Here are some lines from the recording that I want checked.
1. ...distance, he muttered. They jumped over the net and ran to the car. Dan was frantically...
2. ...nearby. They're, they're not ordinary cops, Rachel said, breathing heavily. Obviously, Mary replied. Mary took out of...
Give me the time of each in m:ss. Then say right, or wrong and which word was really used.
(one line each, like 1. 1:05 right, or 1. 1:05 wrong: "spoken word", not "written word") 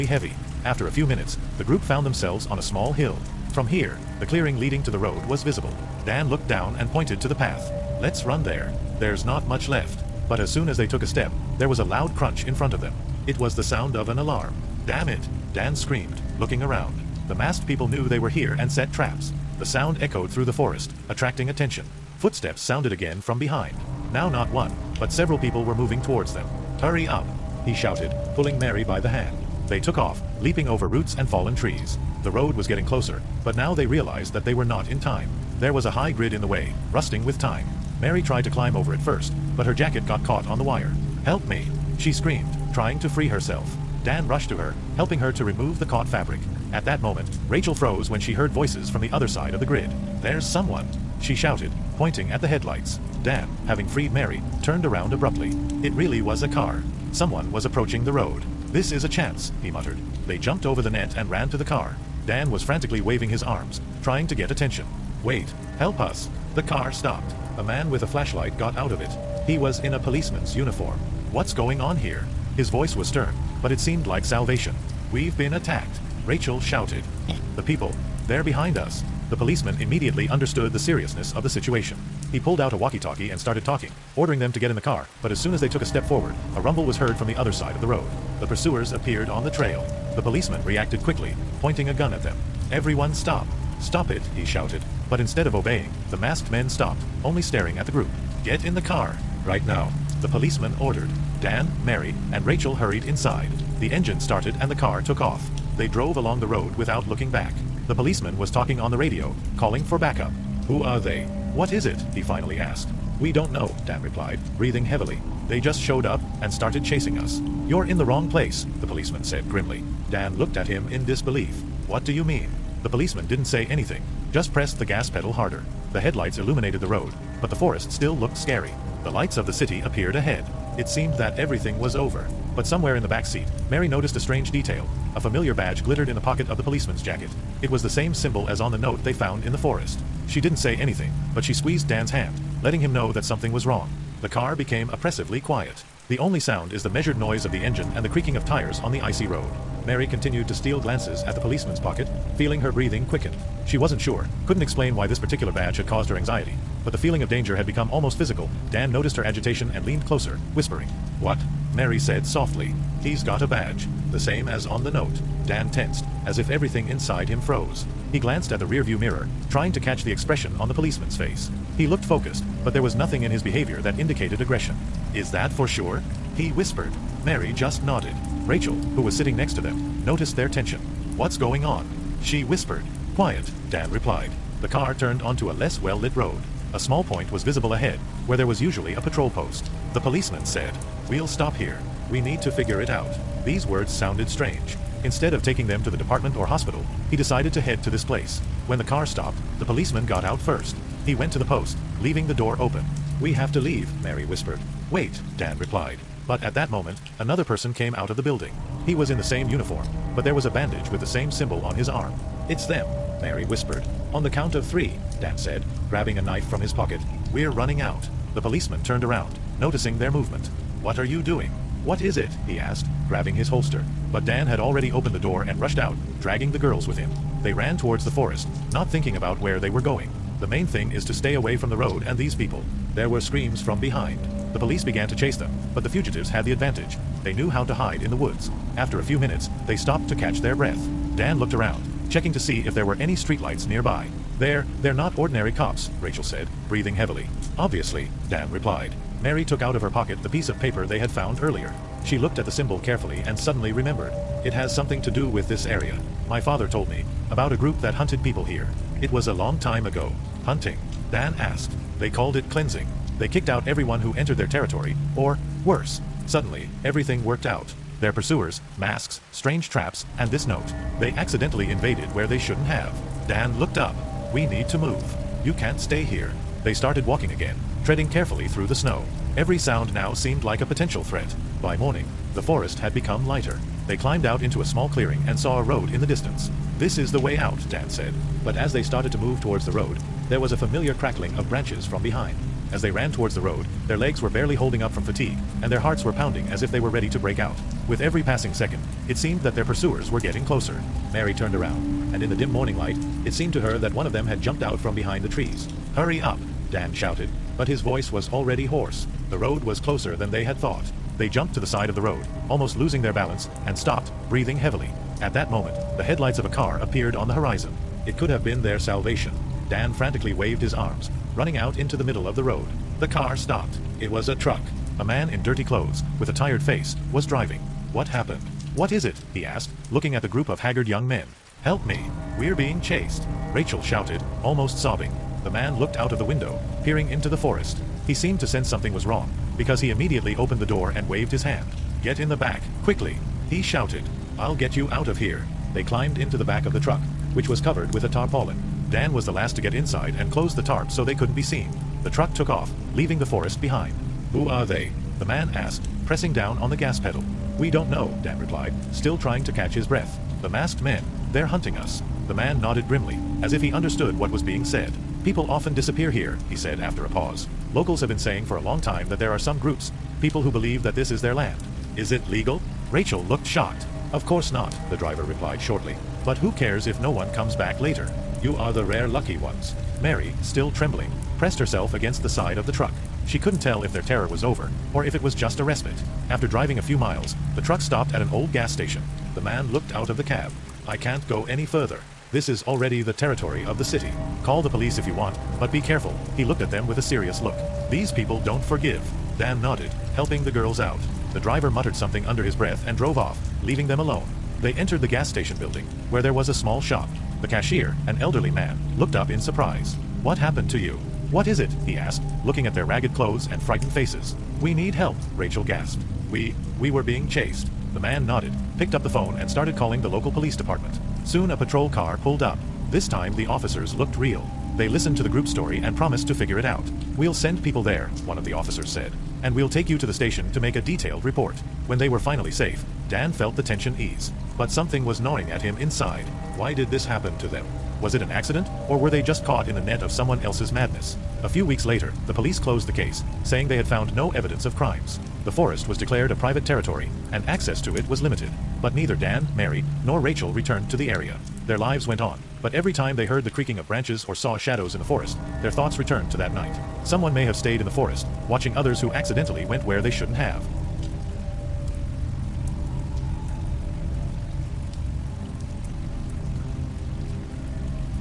1. 0:59 wrong: "chance", not "distance"
2. 4:03 wrong: "Dan", not "Mary".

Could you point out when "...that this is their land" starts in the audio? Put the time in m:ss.
6:10.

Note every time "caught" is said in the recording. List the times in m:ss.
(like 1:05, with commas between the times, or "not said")
0:40, 0:45, 7:19.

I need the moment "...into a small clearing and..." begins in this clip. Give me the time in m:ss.
4:44.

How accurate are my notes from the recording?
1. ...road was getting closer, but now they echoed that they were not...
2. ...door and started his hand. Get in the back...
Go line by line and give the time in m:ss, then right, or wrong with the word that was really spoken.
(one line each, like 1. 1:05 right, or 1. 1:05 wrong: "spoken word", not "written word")
1. 0:32 wrong: "realized", not "echoed"
2. 5:40 wrong: "waved", not "started".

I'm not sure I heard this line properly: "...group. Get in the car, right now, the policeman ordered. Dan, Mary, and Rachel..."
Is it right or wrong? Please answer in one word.
right.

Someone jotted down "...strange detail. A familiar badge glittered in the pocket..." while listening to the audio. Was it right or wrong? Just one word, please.
right.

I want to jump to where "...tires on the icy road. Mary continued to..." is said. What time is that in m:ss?
2:28.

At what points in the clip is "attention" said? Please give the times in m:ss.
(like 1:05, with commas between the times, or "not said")
0:21, 1:04.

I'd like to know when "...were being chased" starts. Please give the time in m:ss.
6:56.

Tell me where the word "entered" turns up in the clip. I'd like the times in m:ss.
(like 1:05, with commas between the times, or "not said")
4:24, 6:44.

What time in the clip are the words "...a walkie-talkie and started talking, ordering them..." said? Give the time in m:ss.
1:22.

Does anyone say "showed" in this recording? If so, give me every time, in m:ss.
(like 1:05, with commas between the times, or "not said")
1:55.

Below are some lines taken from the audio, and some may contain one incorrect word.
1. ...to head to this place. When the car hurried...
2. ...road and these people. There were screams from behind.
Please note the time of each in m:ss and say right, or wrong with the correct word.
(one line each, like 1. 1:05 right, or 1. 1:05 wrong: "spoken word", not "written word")
1. 3:17 wrong: "stopped", not "hurried"
2. 3:51 right.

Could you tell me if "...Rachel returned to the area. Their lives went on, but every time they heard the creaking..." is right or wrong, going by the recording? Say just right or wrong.
right.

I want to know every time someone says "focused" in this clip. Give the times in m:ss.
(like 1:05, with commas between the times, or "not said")
2:52.